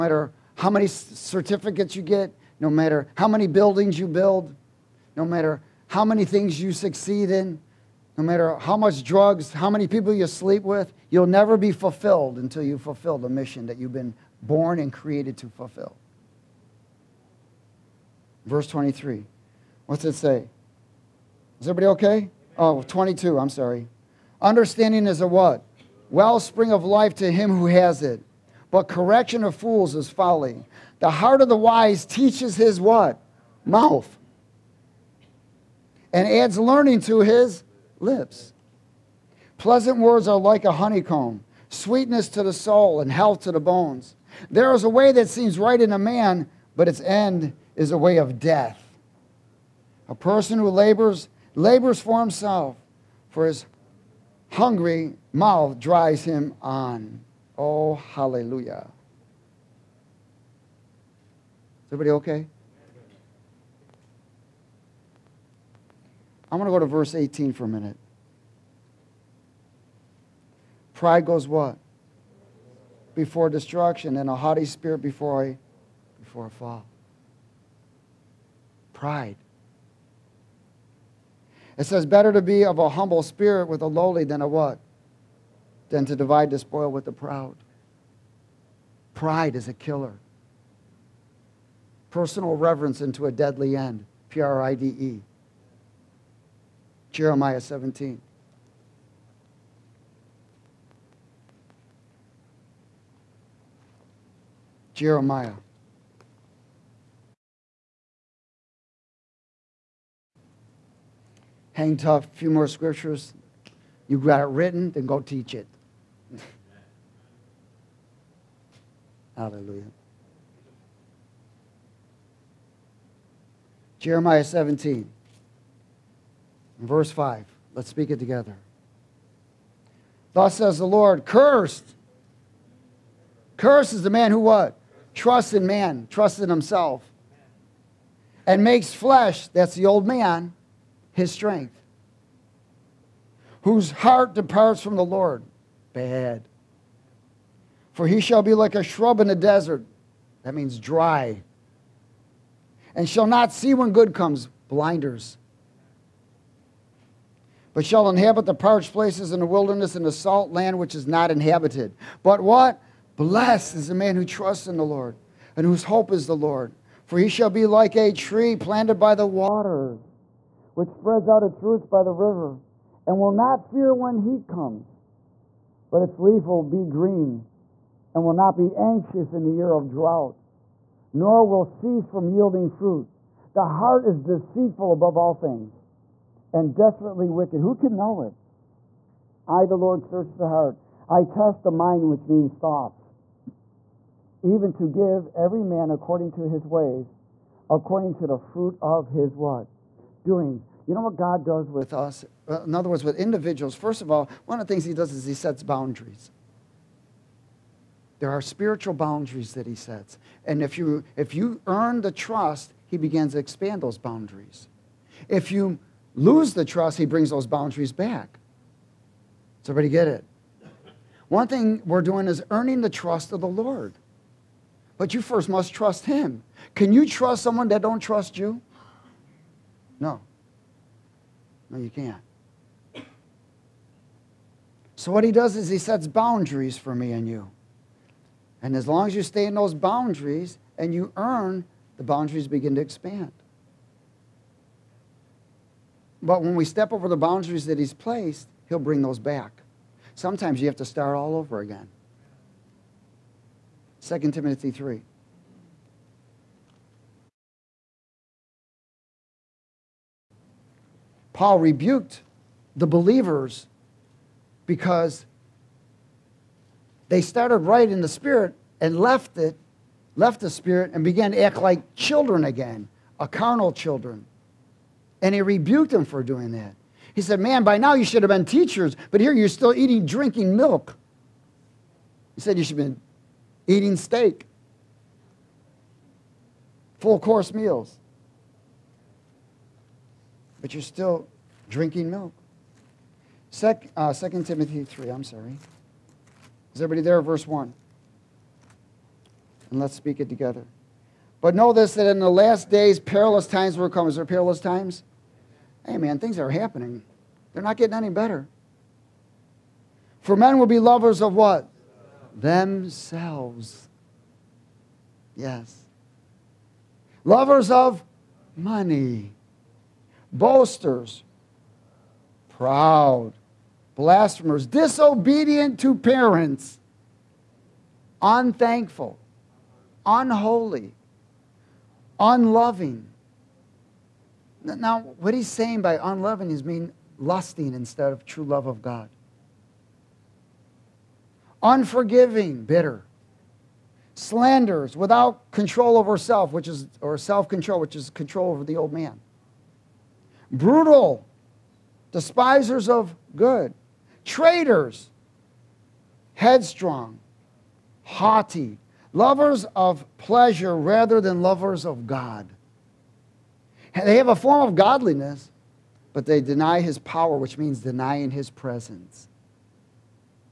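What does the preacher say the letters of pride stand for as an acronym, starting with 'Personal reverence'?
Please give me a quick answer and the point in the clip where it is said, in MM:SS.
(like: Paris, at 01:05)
Personal reverence into a deadly end, at 01:32.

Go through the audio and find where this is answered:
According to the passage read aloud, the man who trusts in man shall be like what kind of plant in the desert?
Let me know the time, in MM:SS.
02:28.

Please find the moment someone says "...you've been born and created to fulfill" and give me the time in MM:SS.
00:13.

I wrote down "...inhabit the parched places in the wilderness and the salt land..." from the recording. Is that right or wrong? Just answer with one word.
right.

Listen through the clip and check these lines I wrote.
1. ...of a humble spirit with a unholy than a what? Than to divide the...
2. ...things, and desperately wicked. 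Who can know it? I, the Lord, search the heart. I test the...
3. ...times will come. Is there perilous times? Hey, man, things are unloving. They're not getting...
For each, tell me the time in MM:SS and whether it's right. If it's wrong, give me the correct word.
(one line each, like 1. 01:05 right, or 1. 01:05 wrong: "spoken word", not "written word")
1. 01:22 wrong: "lowly", not "unholy"
2. 03:05 right
3. 05:03 wrong: "happening", not "unloving".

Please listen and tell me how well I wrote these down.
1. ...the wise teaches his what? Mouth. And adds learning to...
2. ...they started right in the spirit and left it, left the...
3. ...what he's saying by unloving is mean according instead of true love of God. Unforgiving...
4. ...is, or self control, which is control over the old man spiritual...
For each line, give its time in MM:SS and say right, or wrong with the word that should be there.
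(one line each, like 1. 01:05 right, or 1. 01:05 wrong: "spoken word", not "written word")
1. 00:31 right
2. 04:27 right
3. 05:35 wrong: "lusting", not "according"
4. 05:46 wrong: "brutal", not "spiritual".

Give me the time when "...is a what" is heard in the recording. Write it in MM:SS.
00:25.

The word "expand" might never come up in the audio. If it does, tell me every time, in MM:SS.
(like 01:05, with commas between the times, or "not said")
03:33, 04:02.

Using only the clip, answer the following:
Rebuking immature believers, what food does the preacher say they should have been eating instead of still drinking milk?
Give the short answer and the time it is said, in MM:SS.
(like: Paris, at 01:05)
Steak, at 04:43.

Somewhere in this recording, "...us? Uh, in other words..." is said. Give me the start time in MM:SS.
03:21.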